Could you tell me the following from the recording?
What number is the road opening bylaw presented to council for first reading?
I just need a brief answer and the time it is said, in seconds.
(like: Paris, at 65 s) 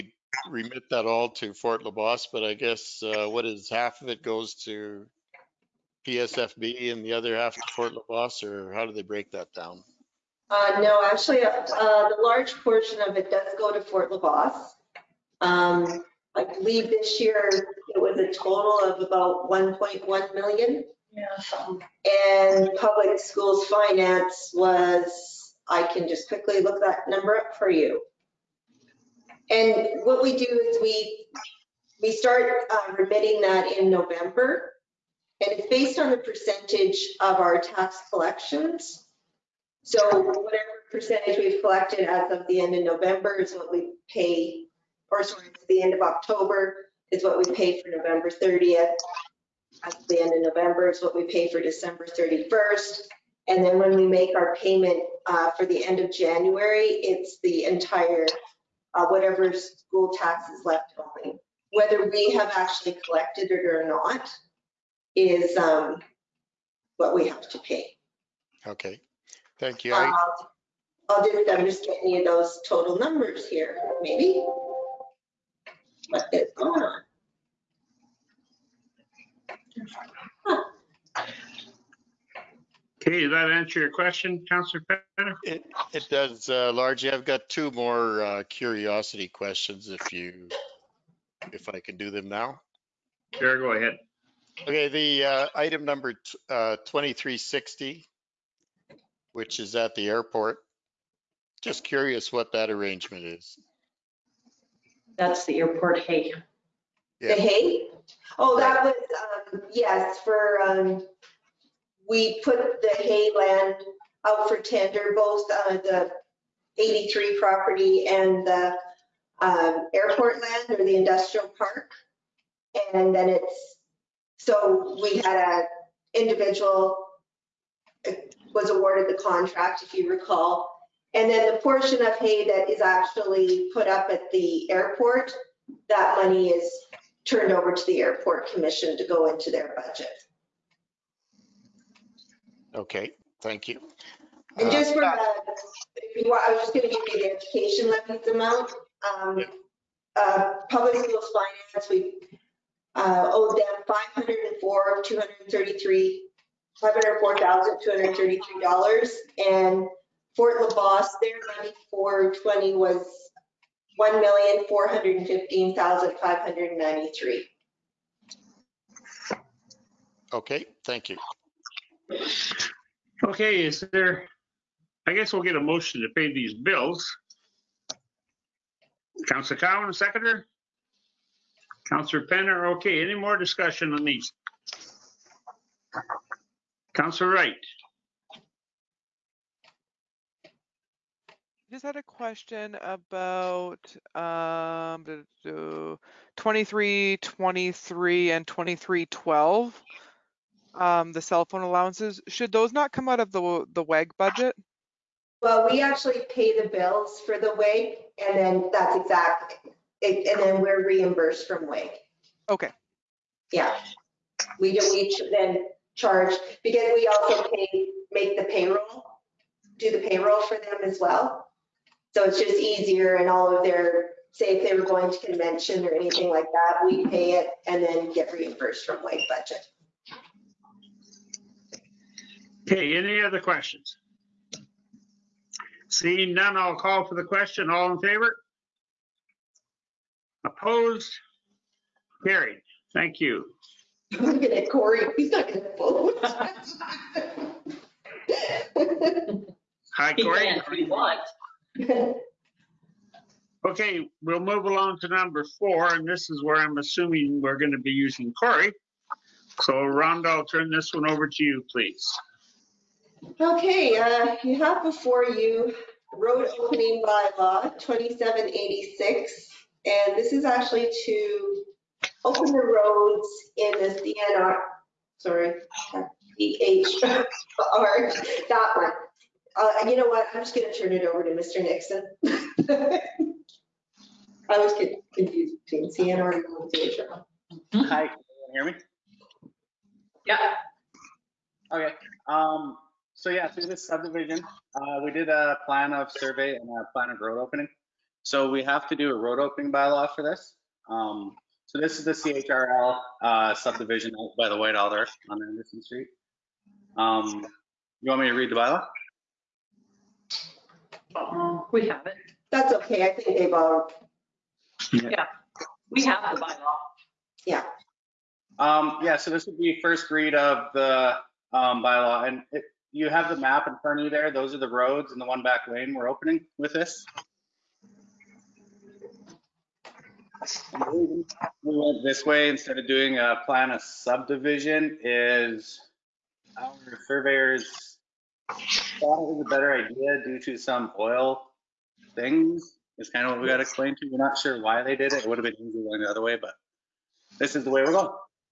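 2786, at 267 s.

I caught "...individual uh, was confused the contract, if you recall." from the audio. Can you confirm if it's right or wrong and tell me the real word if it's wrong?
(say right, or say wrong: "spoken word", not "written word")
wrong: "awarded", not "confused".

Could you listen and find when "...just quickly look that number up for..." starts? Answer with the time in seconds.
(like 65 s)
26 s.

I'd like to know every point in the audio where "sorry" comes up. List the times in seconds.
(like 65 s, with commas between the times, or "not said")
45 s, 275 s.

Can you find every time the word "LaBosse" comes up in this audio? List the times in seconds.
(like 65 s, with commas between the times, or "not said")
1 s, 7 s, 14 s, 160 s.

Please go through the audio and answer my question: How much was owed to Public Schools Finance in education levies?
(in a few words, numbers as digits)
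$504,233.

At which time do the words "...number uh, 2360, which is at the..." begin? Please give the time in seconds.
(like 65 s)
95 s.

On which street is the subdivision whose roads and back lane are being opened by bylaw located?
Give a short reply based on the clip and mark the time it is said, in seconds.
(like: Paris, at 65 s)
Anderson Street, at 305 s.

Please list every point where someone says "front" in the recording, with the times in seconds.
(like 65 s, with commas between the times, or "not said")
323 s.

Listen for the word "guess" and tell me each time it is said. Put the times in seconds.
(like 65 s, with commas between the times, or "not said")
2 s, 175 s.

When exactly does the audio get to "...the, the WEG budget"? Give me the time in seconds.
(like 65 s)
203 s.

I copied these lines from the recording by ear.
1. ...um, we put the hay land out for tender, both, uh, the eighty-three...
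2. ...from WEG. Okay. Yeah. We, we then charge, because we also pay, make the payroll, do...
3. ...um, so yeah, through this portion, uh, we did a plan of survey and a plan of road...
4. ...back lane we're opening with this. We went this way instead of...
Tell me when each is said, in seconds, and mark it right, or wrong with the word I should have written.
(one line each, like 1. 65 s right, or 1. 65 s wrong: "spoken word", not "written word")
1. 110 s right
2. 211 s right
3. 292 s wrong: "subdivision", not "portion"
4. 325 s right.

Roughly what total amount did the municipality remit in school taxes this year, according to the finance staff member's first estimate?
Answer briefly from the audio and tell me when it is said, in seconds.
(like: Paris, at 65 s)
1.1 million, at 19 s.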